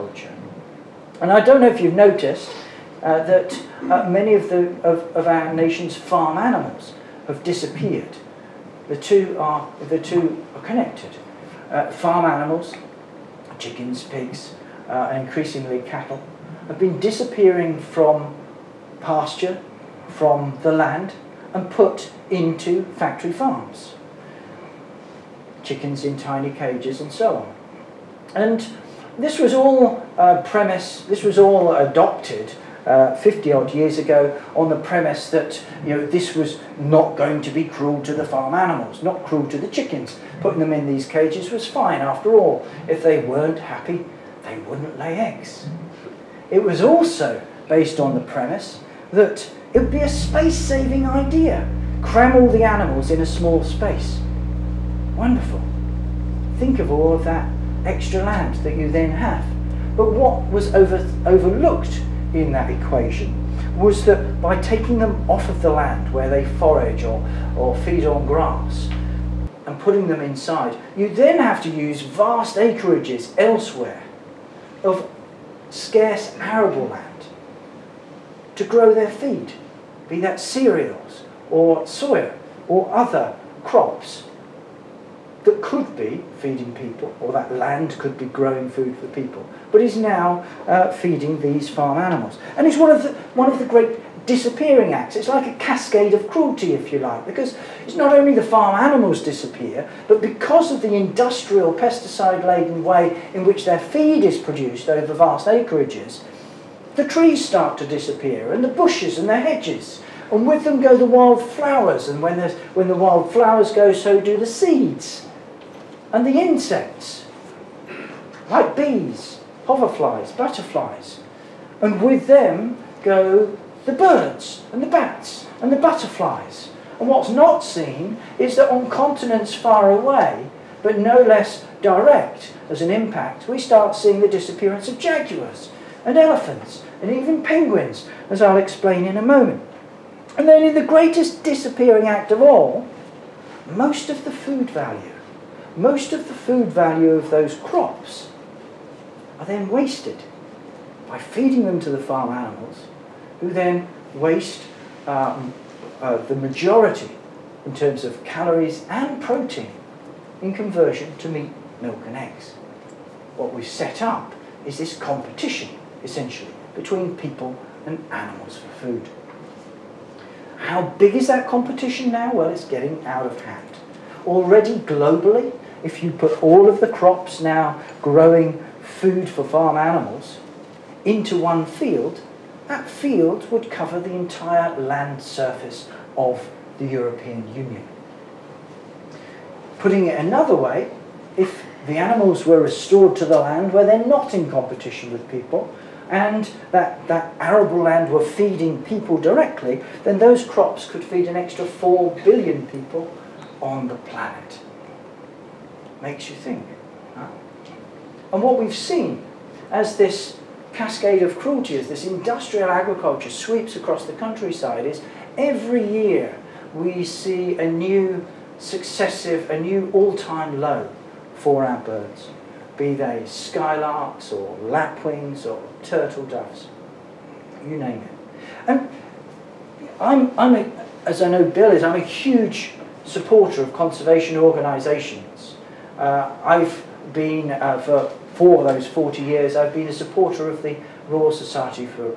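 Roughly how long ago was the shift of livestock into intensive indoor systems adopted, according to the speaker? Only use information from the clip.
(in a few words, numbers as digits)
50 odd years ago.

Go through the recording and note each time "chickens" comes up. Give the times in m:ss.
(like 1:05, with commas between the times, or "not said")
0:13, 0:25, 0:39.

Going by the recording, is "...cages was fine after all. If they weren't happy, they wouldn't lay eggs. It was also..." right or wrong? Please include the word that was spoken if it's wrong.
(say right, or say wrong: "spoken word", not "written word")
right.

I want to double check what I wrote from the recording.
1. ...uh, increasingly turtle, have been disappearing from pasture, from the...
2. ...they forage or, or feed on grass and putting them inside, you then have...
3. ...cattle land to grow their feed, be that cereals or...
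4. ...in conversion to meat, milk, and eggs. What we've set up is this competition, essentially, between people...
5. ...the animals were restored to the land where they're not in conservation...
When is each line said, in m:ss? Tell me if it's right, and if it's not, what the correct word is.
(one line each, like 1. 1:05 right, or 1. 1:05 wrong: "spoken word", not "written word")
1. 0:14 wrong: "cattle", not "turtle"
2. 1:06 right
3. 1:16 wrong: "arable", not "cattle"
4. 2:40 right
5. 3:11 wrong: "competition", not "conservation".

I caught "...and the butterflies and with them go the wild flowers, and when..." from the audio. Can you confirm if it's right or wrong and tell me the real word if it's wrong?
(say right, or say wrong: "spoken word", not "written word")
wrong: "hedges", not "butterflies".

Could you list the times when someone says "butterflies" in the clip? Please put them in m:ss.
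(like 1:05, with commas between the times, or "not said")
2:00, 2:05.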